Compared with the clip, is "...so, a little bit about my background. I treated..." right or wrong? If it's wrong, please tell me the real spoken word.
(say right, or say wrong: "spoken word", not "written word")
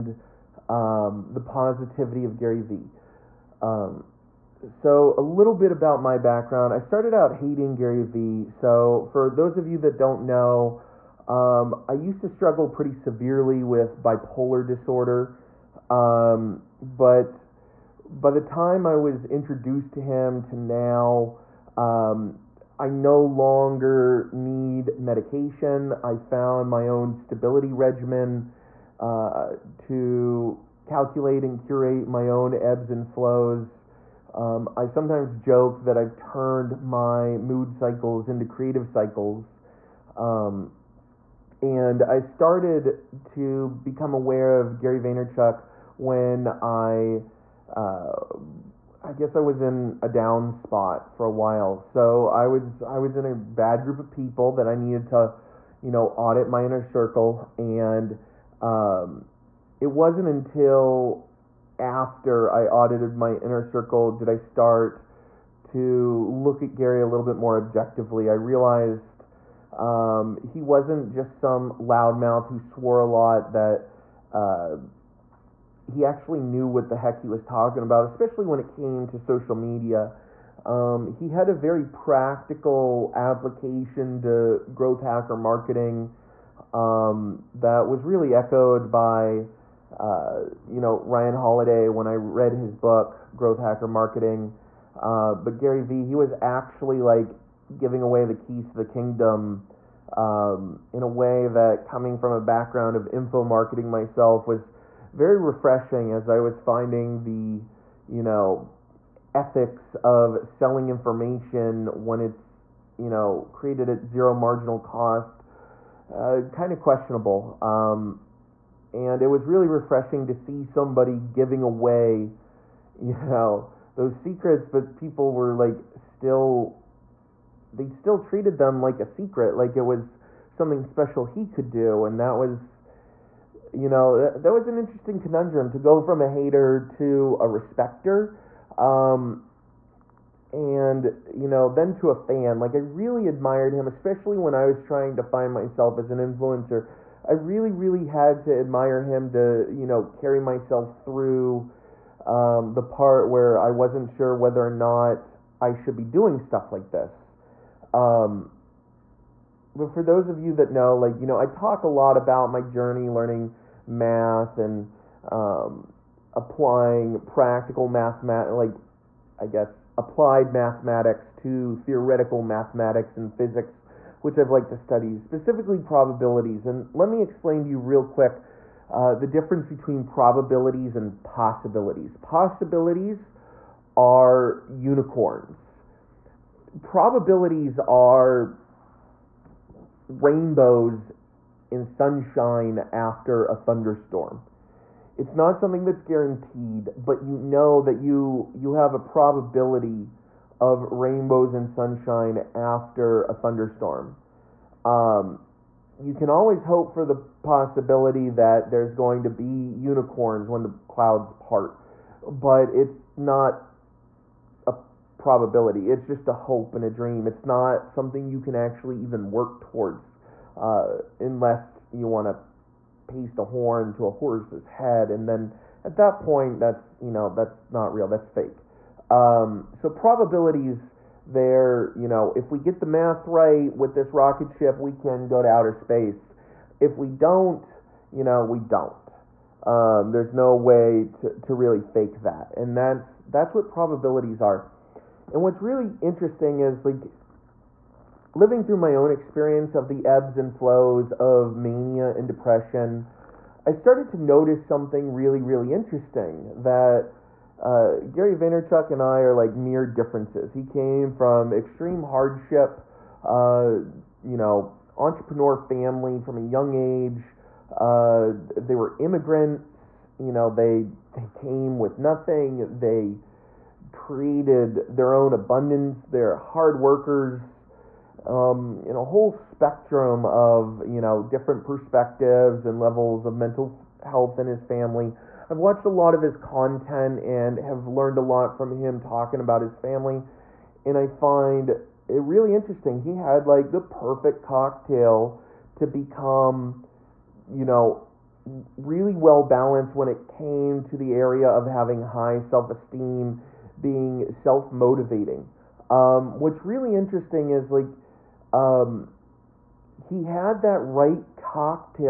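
wrong: "started", not "treated".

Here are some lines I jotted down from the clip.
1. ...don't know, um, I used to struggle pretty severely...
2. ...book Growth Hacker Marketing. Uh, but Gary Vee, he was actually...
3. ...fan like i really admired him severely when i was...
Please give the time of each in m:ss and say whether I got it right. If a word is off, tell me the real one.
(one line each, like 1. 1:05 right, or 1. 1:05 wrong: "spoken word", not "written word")
1. 0:09 right
2. 1:32 right
3. 2:22 wrong: "especially", not "severely".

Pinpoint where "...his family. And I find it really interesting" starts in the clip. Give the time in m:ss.
4:49.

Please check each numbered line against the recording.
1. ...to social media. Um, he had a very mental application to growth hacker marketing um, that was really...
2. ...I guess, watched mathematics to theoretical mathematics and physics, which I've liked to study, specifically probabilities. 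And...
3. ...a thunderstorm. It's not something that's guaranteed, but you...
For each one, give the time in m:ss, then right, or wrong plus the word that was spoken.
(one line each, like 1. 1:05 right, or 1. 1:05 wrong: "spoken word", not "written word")
1. 1:19 wrong: "practical", not "mental"
2. 2:49 wrong: "applied", not "watched"
3. 3:13 right.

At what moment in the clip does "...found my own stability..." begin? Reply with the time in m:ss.
0:26.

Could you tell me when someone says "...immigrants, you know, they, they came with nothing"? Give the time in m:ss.
4:28.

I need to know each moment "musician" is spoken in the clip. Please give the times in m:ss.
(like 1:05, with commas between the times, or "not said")
not said.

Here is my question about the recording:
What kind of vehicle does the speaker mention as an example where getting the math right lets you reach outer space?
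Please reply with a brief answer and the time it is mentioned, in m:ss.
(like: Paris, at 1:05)
Rocket ship, at 3:54.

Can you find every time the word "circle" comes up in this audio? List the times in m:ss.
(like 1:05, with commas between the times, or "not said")
0:56, 1:03.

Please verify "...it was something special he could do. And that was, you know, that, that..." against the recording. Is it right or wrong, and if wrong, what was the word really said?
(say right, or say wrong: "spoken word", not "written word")
right.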